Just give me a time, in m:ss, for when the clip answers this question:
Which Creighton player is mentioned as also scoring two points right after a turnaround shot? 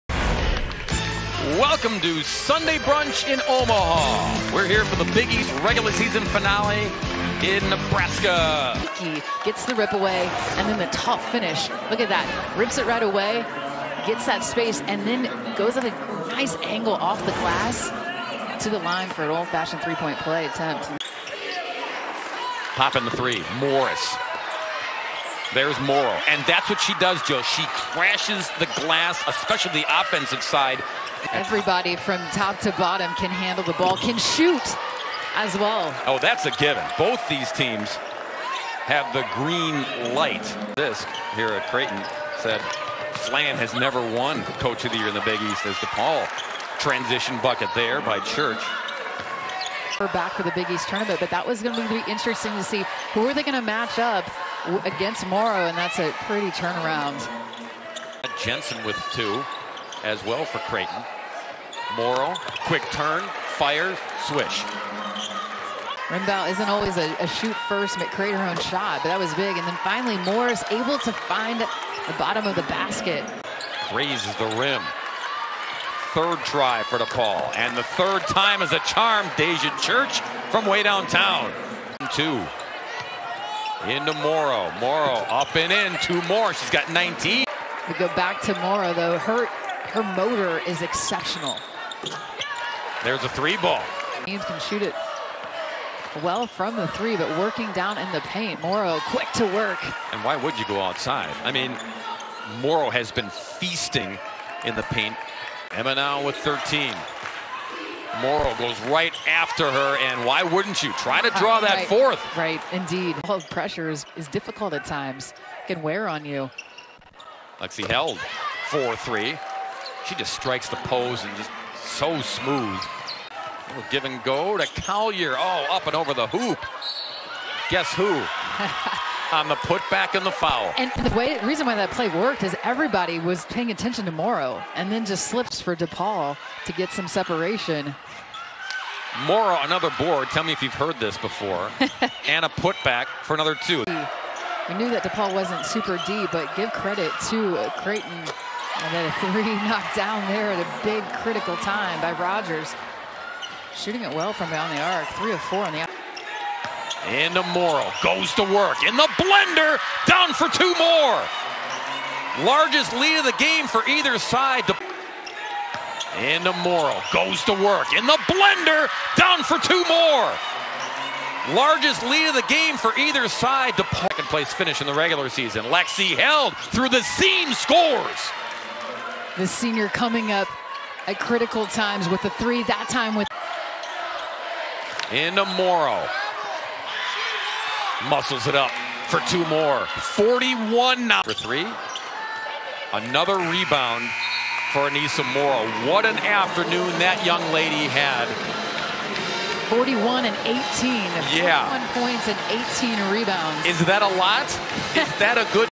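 0:58.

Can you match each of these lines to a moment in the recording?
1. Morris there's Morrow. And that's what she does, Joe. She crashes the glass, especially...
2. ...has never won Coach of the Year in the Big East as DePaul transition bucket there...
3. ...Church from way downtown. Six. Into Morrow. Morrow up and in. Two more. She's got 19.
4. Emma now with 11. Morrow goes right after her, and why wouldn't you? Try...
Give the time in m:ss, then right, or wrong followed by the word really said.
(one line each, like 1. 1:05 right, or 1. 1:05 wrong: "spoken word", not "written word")
1. 0:23 right
2. 0:43 right
3. 1:19 wrong: "Two", not "Six"
4. 1:45 wrong: "13", not "11".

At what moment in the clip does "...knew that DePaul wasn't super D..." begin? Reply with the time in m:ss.
2:24.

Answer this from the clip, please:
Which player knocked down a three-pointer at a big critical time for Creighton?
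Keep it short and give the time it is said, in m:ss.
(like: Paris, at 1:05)
Rogers, at 2:32.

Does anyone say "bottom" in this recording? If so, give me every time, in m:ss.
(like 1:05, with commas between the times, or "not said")
0:32, 1:12.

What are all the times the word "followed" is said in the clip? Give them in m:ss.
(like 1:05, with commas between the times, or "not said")
not said.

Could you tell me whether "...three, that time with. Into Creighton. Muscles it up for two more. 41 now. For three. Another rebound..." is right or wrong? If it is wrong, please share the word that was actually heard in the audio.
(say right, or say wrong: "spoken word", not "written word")
wrong: "Morrow", not "Creighton".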